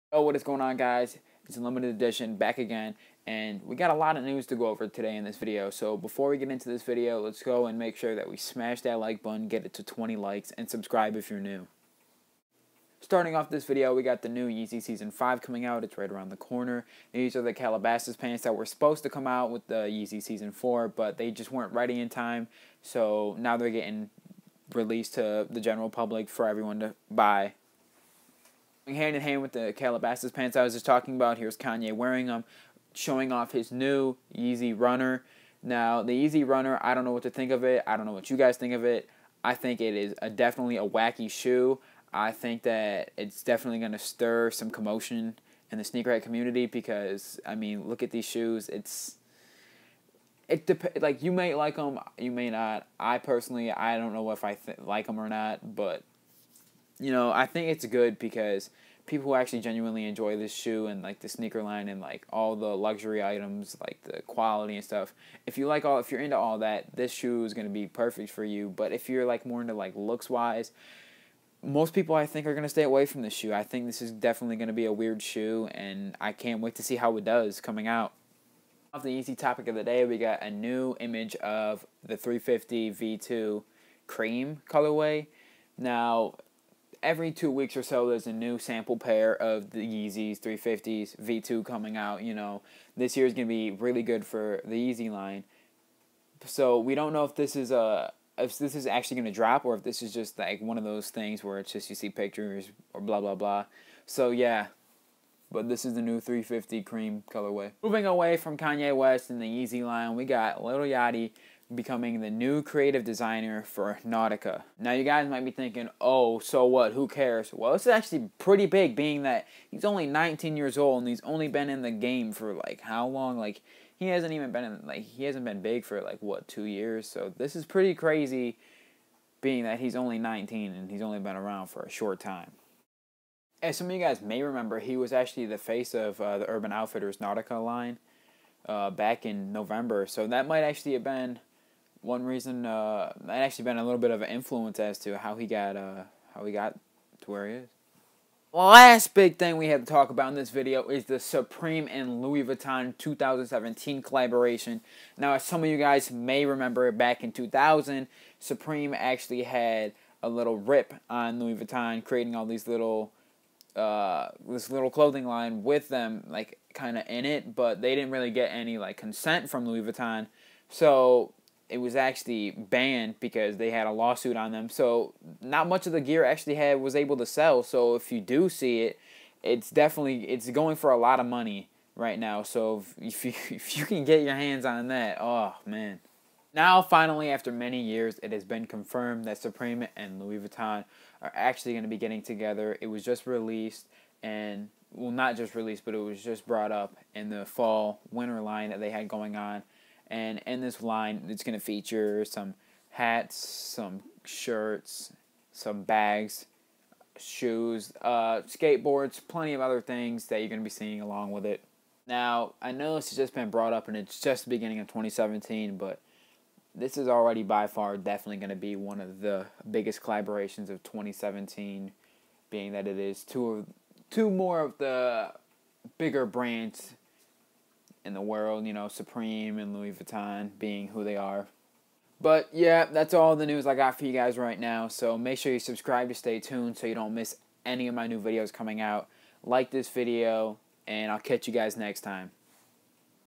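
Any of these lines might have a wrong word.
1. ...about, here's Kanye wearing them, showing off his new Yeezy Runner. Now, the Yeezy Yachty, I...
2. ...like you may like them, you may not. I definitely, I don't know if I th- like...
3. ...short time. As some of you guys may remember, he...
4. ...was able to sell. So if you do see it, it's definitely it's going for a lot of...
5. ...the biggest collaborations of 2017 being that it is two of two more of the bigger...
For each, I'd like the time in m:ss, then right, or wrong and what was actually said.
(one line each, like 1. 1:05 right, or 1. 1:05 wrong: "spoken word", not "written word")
1. 0:31 wrong: "Runner", not "Yachty"
2. 0:51 wrong: "personally", not "definitely"
3. 2:11 right
4. 2:56 right
5. 3:39 right.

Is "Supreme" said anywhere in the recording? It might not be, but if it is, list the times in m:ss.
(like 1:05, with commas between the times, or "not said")
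2:31, 2:38, 3:09, 3:48.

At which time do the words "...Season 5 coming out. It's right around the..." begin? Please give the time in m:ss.
0:14.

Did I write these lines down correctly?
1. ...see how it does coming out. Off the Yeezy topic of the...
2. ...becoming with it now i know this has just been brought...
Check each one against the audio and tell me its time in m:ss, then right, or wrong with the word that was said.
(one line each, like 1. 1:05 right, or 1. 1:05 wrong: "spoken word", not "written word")
1. 1:16 right
2. 3:31 wrong: "along", not "becoming".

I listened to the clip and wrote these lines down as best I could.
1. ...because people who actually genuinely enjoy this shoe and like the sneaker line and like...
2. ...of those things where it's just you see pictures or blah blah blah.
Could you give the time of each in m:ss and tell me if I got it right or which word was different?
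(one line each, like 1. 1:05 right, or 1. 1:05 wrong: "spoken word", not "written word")
1. 0:58 right
2. 1:40 right.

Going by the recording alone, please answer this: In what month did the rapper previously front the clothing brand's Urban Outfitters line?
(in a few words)
November.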